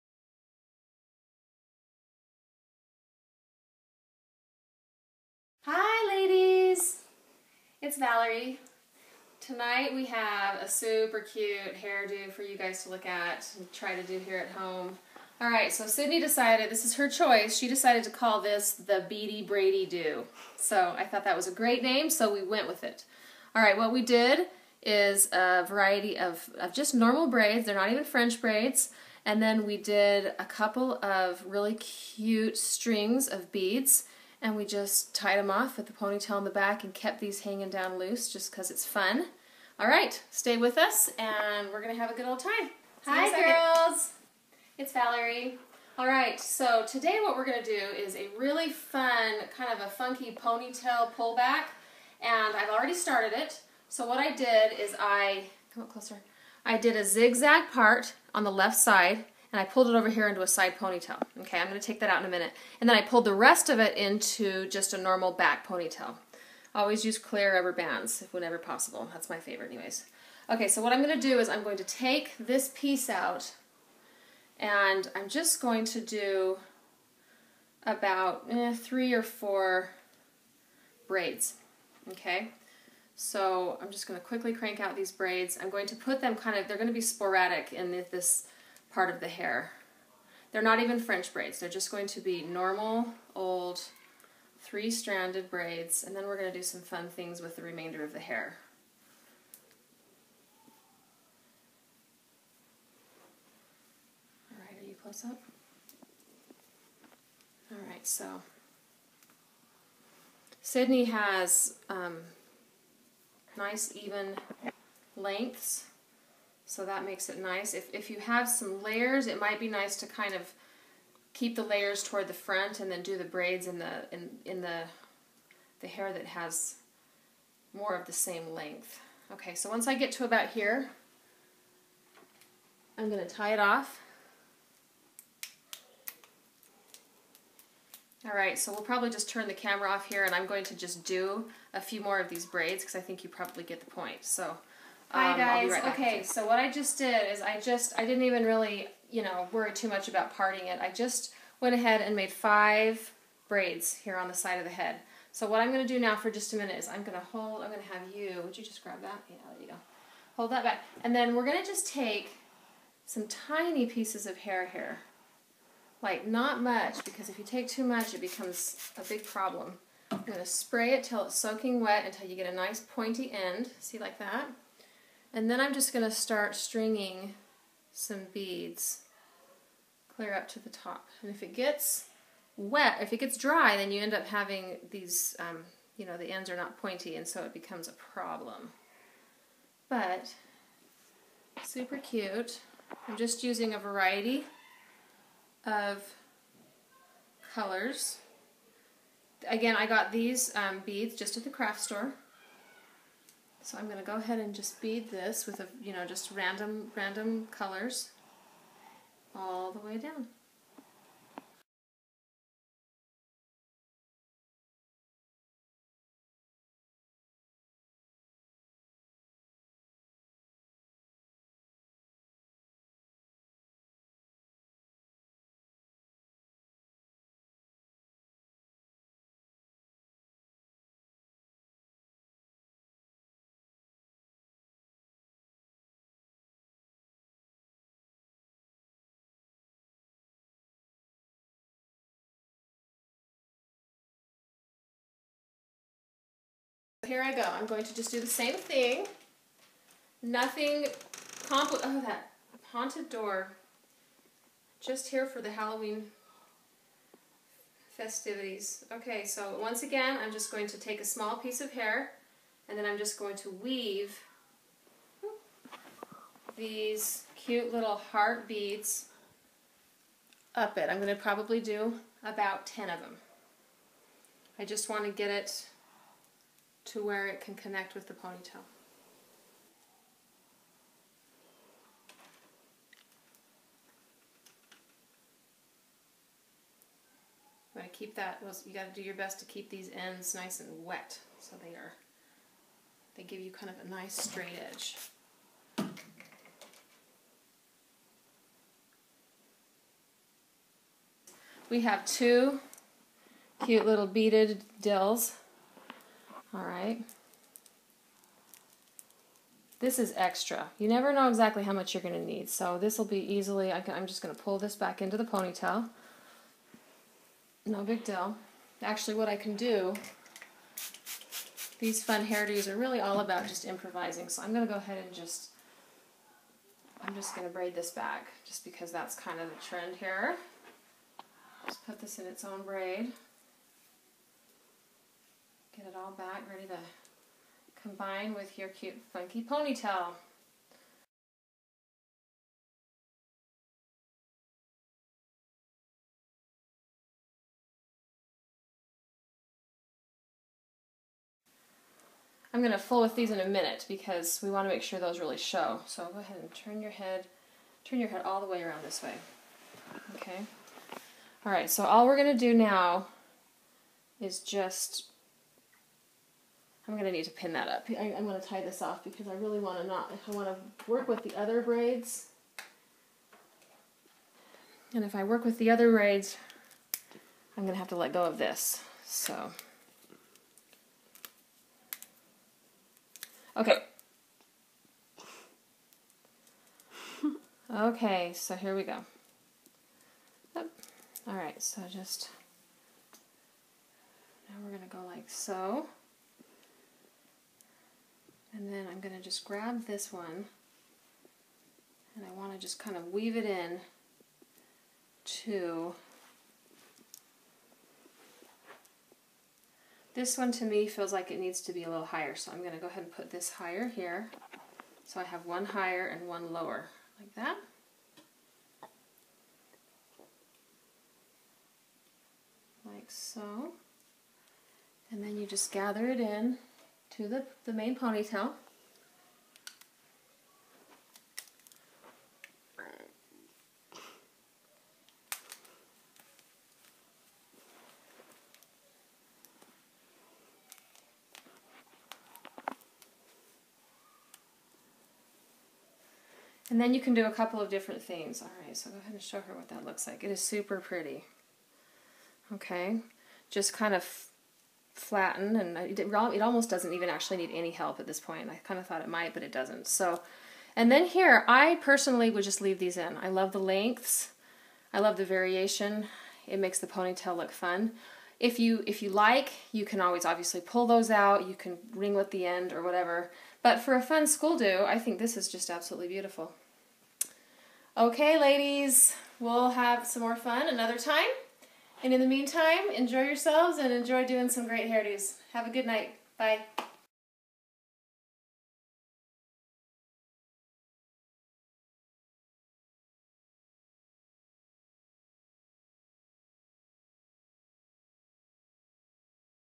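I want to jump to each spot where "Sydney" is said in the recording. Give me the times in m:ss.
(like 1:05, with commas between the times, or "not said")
0:15, 1:50.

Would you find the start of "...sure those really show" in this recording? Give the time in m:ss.
5:54.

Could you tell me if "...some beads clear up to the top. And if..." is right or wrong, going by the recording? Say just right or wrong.
right.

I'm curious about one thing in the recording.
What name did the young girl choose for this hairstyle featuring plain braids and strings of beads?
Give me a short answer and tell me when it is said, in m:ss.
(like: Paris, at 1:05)
Beady Braidy Do, at 0:19.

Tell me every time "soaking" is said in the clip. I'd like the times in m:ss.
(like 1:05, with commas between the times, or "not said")
2:51.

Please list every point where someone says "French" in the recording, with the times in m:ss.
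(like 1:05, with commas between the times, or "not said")
0:28, 1:30.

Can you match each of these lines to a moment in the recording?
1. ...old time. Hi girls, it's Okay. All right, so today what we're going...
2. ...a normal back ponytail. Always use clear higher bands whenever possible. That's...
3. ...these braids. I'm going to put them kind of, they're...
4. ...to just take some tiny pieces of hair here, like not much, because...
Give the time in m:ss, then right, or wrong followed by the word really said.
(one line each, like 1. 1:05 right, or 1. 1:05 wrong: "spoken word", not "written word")
1. 0:42 wrong: "Valerie", not "Okay"
2. 1:04 wrong: "rubber", not "higher"
3. 1:24 right
4. 2:41 right.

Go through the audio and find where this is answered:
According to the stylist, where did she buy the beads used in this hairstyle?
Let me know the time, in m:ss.
3:21.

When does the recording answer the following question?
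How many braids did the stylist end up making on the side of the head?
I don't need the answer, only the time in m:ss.
2:32.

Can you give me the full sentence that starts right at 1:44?
All right, are you close up?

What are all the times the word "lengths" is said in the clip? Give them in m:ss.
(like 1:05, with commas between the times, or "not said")
1:55, 2:08, 7:43.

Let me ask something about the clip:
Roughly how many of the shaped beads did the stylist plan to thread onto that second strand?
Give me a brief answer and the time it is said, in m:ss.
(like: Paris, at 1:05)
10, at 4:32.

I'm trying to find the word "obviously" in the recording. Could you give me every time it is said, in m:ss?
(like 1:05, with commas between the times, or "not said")
7:50.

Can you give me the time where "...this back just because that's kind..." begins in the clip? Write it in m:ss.
5:27.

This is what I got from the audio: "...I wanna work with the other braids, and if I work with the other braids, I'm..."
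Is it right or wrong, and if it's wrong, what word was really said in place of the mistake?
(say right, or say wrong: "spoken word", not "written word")
right.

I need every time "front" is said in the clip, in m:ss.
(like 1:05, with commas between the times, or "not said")
2:02.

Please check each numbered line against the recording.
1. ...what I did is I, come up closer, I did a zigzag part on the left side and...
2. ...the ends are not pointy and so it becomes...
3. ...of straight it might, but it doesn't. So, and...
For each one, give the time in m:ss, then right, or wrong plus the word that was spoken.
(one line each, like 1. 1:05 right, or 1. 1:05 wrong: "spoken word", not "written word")
1. 0:54 right
2. 3:06 right
3. 7:38 wrong: "thought", not "straight".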